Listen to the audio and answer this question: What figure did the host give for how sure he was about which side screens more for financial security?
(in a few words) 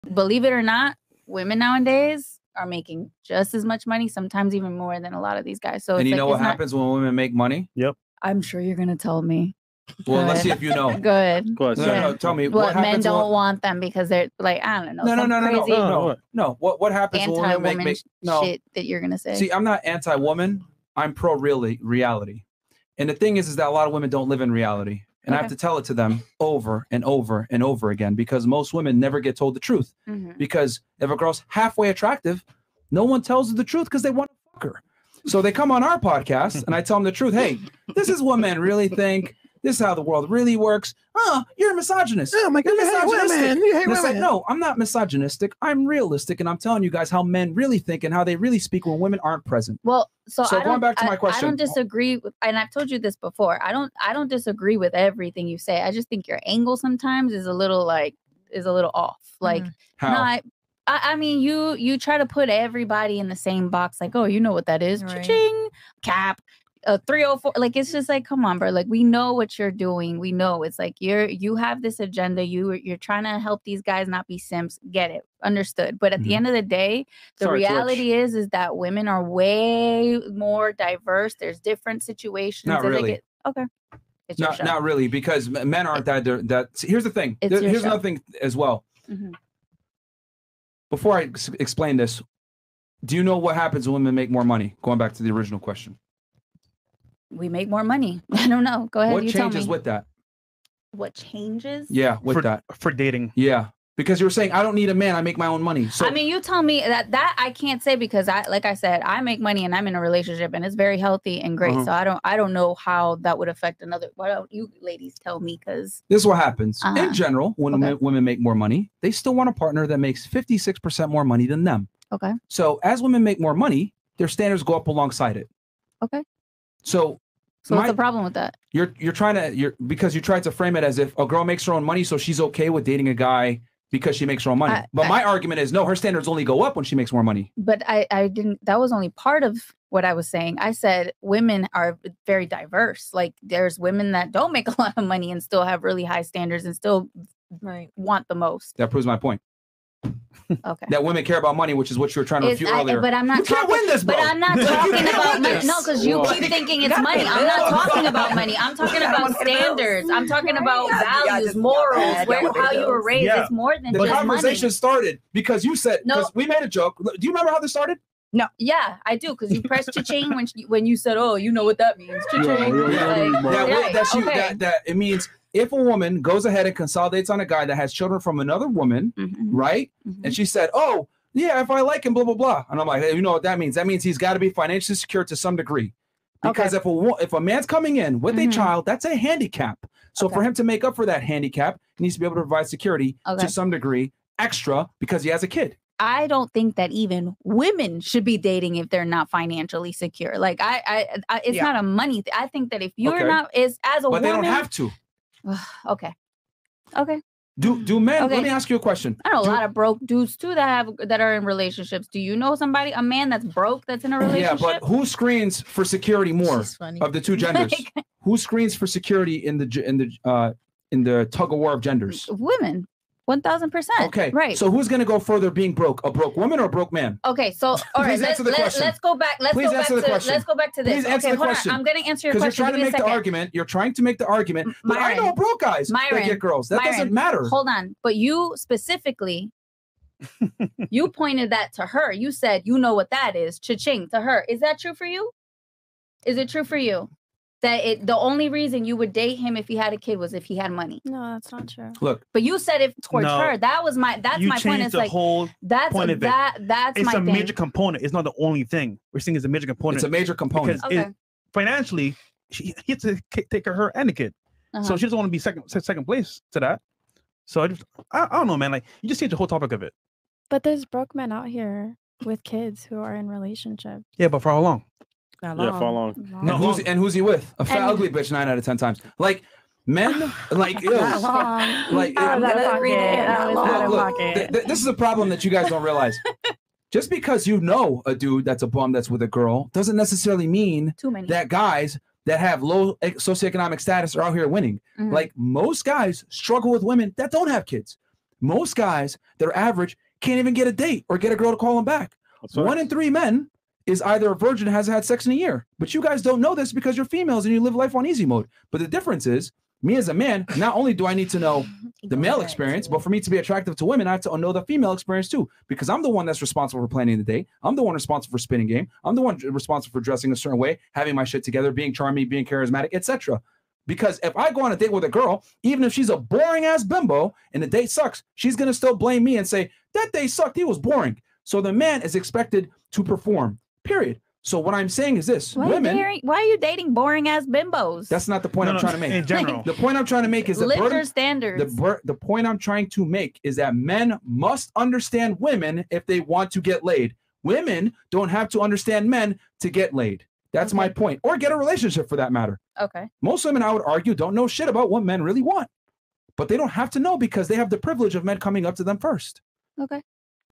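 1000 percent.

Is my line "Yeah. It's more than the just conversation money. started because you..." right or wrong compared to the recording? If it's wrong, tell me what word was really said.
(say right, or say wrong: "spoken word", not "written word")
right.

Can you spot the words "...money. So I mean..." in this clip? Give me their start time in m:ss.
1:45.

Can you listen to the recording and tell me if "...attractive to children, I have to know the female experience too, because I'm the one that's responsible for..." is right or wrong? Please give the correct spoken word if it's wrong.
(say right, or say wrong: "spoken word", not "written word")
wrong: "women", not "children".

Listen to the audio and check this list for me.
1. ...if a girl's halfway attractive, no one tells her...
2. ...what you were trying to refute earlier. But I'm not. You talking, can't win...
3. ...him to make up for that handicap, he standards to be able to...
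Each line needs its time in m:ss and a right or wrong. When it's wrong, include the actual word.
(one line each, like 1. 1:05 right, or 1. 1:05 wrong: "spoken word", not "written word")
1. 0:30 right
2. 2:31 right
3. 3:10 wrong: "needs", not "standards".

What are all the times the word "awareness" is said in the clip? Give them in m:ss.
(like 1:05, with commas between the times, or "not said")
not said.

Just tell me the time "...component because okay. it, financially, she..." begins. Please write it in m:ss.
4:20.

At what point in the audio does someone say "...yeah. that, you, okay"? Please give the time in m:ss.
2:53.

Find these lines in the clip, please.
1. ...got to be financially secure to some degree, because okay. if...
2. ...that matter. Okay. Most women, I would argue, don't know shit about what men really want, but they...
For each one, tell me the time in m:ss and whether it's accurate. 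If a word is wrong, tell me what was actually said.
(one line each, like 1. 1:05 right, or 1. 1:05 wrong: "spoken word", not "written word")
1. 3:04 right
2. 5:52 right.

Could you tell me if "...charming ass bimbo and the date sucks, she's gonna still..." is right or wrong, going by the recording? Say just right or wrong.
wrong.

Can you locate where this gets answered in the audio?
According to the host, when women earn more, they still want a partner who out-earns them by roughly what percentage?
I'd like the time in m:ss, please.
2:00.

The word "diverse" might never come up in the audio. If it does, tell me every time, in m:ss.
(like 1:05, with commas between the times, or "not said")
1:20, 2:22.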